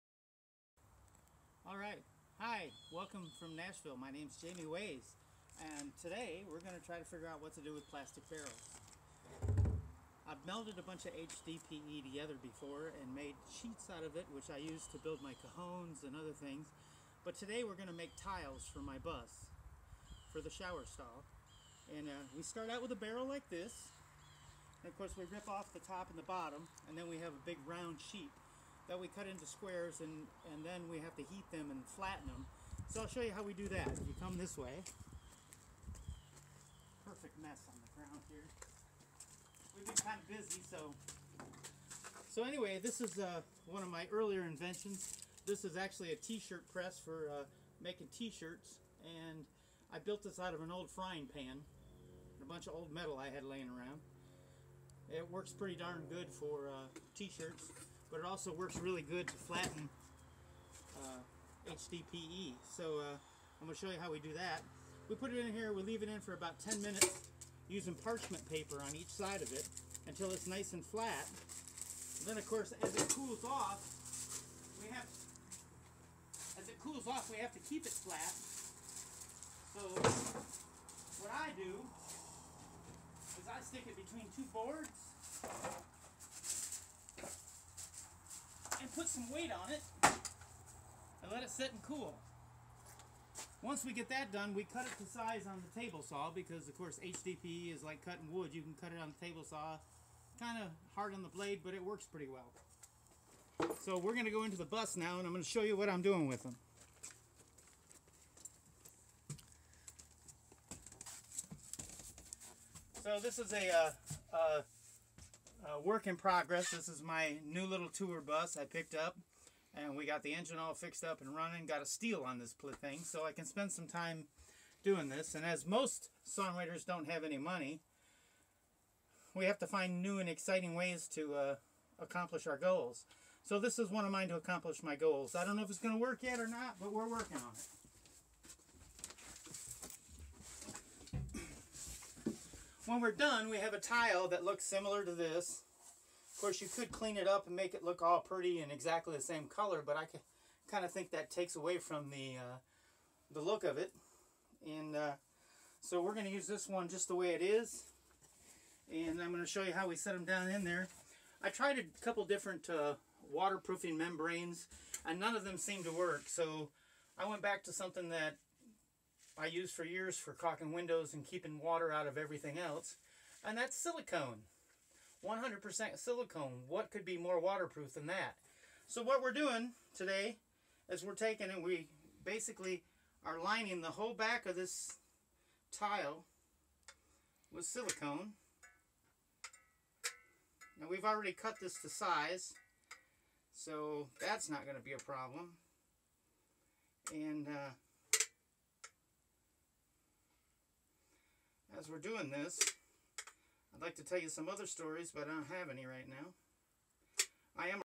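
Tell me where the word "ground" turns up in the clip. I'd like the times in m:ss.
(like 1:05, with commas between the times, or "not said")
0:37.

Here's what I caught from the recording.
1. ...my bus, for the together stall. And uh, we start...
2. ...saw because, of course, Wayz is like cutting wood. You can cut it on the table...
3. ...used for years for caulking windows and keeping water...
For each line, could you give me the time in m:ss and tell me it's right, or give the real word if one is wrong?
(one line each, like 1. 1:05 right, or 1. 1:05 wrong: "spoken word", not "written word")
1. 0:18 wrong: "shower", not "together"
2. 1:36 wrong: "HDPE", not "Wayz"
3. 2:49 right.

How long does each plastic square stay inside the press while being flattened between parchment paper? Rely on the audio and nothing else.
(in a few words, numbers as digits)
10 minutes.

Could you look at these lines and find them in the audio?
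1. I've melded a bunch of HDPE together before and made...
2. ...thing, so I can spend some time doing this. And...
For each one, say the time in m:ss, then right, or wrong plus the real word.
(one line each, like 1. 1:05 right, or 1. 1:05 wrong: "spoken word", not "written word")
1. 0:10 right
2. 2:02 right.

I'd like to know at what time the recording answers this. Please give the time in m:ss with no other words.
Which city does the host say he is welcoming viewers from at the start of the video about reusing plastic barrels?
0:03.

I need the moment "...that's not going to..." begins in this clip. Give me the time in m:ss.
3:14.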